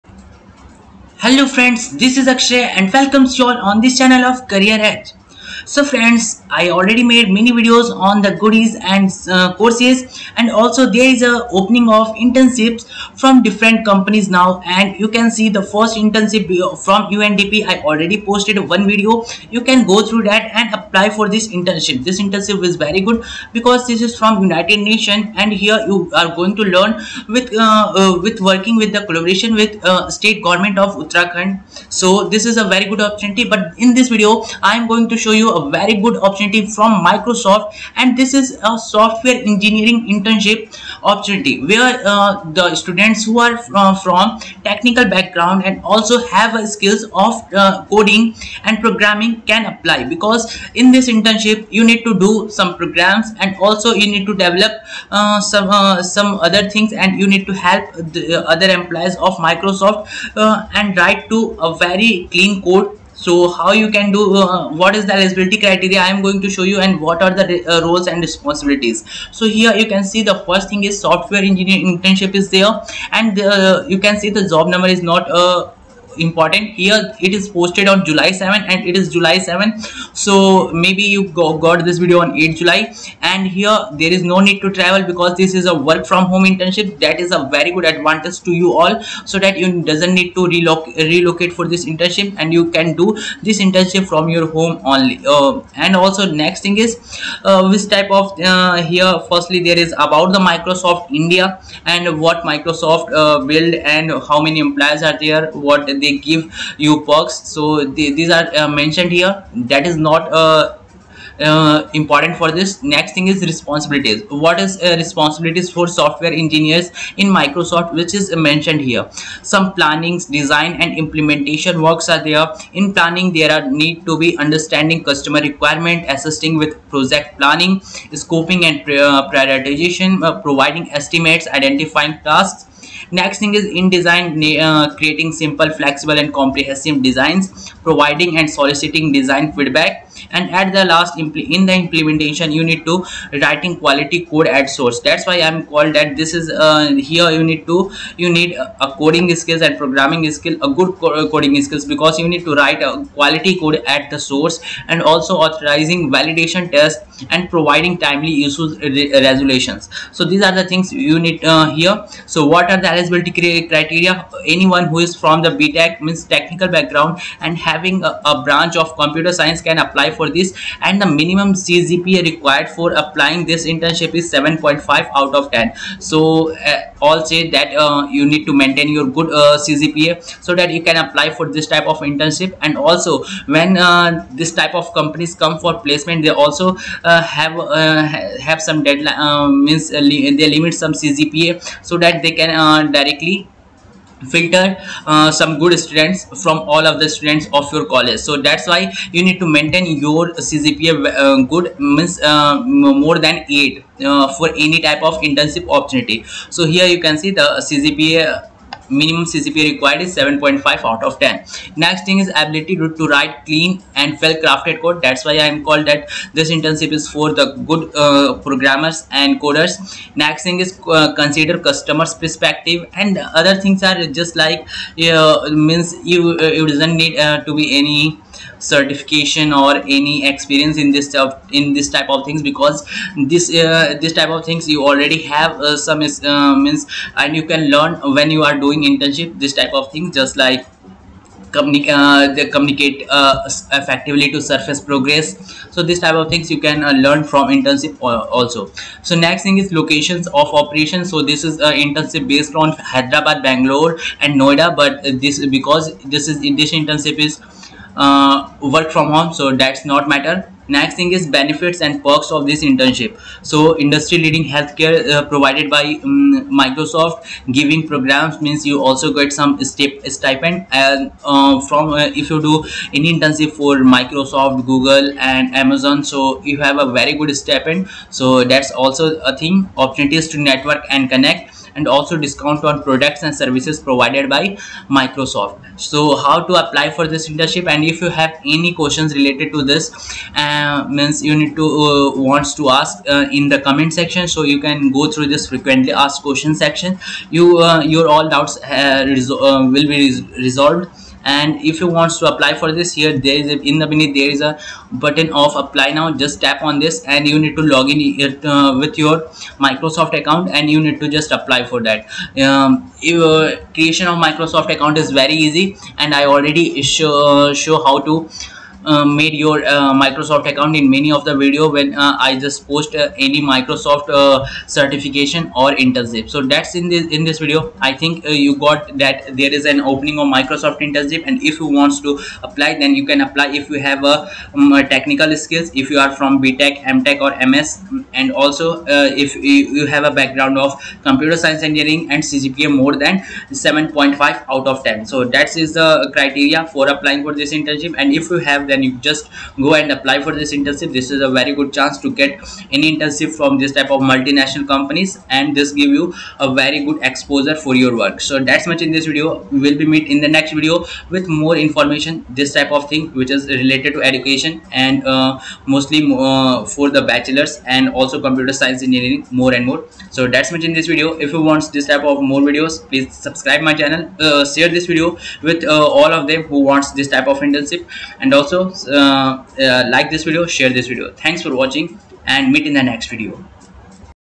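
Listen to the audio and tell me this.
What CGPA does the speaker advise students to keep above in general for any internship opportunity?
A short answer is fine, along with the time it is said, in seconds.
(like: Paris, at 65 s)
8, at 202 s.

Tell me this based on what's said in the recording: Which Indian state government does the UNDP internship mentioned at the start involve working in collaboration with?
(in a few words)
Uttarakhand.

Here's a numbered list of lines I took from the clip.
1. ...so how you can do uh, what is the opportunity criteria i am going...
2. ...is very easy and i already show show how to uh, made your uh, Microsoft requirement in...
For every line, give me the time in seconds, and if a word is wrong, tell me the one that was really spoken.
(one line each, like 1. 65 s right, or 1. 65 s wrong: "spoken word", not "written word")
1. 63 s wrong: "eligibility", not "opportunity"
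2. 315 s wrong: "account", not "requirement".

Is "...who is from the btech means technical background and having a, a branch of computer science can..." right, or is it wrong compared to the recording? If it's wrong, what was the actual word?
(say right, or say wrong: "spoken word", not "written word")
right.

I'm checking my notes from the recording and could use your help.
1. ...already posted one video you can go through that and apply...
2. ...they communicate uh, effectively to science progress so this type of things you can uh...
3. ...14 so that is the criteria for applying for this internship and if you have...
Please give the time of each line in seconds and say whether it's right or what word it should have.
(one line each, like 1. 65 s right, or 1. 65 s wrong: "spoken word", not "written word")
1. 17 s right
2. 242 s wrong: "surface", not "science"
3. 344 s wrong: "10", not "14".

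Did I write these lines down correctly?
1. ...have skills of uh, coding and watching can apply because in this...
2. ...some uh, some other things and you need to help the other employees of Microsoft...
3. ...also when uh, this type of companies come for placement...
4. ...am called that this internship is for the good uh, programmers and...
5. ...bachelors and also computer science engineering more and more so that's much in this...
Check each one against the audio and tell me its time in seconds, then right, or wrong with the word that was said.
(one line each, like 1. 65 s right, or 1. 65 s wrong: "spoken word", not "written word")
1. 46 s wrong: "programming", not "watching"
2. 55 s right
3. 182 s right
4. 215 s right
5. 367 s right.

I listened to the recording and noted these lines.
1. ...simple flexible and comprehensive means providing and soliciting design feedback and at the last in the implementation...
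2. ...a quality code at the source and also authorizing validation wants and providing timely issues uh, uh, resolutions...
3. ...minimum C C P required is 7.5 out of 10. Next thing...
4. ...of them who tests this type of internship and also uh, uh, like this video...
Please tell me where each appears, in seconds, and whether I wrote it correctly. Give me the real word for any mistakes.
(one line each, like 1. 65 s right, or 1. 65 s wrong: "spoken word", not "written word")
1. 135 s wrong: "designs", not "means"
2. 152 s wrong: "tests", not "wants"
3. 208 s right
4. 376 s wrong: "wants", not "tests".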